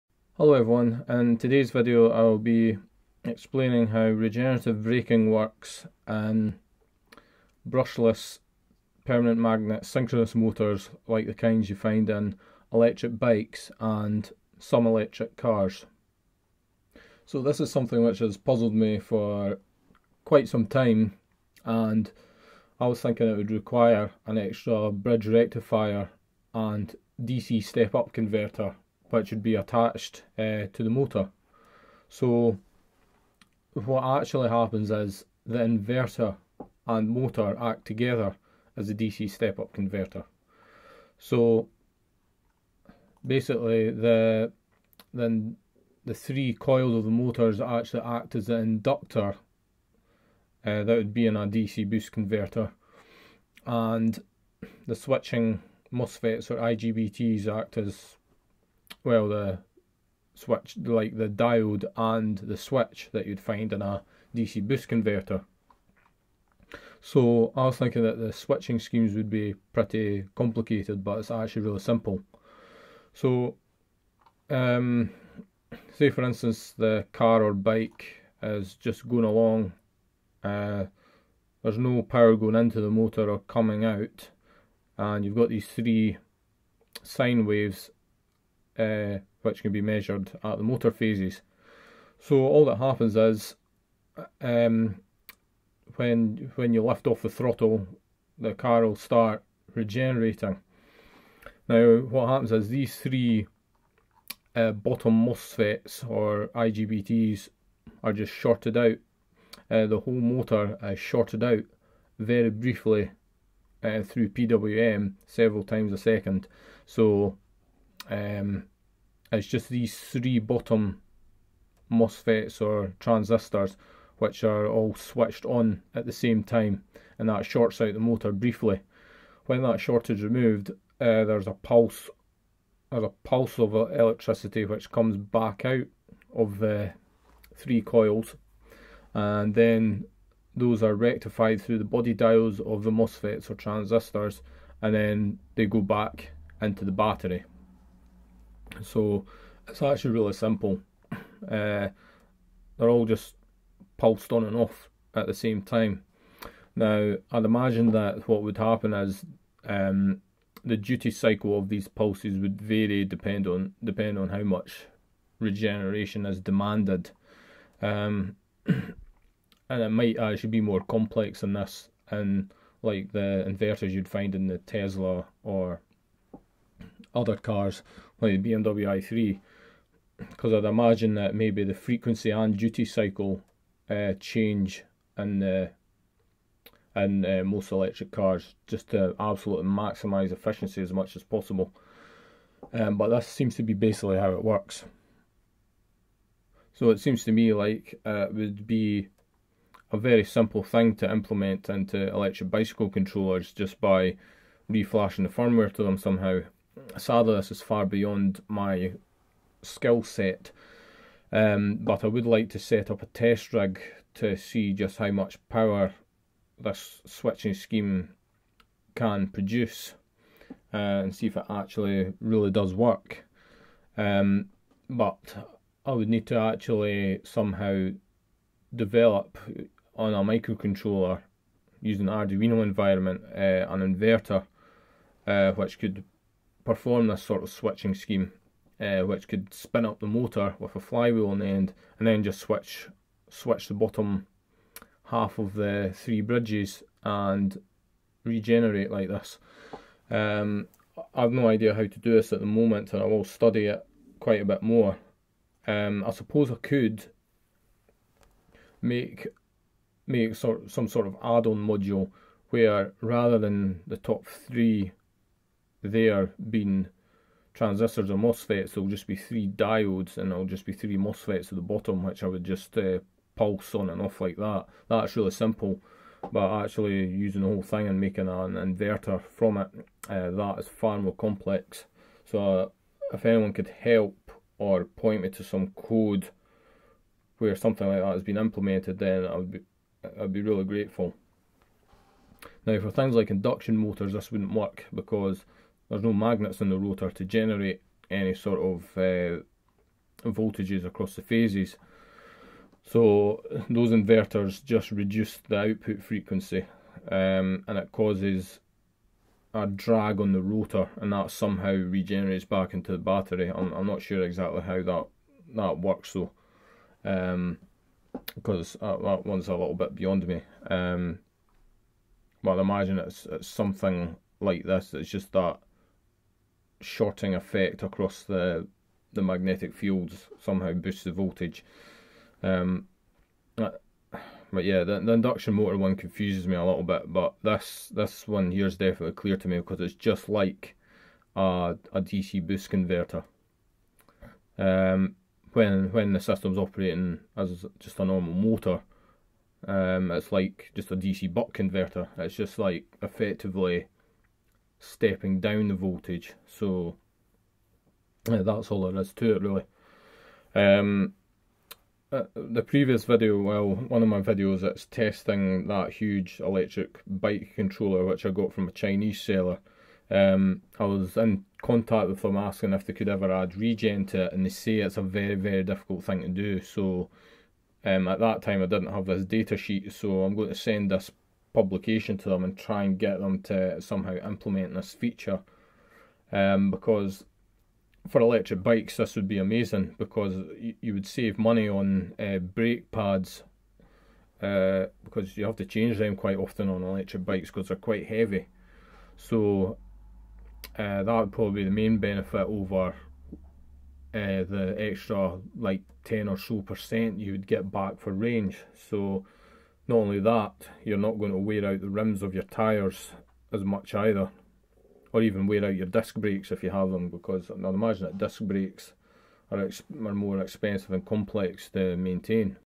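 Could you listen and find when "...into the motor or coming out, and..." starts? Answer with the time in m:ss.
1:22.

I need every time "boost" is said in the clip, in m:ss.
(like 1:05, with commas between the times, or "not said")
0:51, 1:04, 5:30, 5:42.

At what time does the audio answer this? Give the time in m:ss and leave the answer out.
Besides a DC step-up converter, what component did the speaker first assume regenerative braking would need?
0:24.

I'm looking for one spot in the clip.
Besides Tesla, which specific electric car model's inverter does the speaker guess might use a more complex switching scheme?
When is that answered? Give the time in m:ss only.
2:58.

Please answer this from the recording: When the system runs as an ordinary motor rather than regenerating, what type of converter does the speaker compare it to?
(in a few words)
DC buck converter.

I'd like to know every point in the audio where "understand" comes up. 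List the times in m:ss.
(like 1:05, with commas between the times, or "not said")
not said.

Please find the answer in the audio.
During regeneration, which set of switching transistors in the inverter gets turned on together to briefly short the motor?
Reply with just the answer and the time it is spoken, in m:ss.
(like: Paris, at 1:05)
three bottom MOSFETs, at 1:59.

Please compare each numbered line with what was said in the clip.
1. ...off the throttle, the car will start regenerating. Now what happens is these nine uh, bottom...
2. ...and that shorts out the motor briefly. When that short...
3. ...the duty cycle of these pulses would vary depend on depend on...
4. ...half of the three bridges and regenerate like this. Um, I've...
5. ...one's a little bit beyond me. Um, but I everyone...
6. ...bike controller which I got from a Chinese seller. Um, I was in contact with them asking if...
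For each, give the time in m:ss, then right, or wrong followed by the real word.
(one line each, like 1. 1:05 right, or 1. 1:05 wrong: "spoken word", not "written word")
1. 1:37 wrong: "three", not "nine"
2. 2:07 right
3. 2:40 right
4. 4:05 right
5. 5:19 wrong: "imagine", not "everyone"
6. 6:07 right.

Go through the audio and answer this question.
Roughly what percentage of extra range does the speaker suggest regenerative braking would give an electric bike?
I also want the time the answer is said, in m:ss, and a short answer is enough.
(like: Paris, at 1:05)
10 percent, at 6:46.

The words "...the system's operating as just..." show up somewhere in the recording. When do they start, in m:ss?
5:46.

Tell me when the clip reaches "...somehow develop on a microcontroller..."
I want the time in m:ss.
3:47.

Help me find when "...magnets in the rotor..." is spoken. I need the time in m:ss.
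4:56.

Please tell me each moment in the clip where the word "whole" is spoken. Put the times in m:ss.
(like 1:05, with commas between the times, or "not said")
1:50, 4:37.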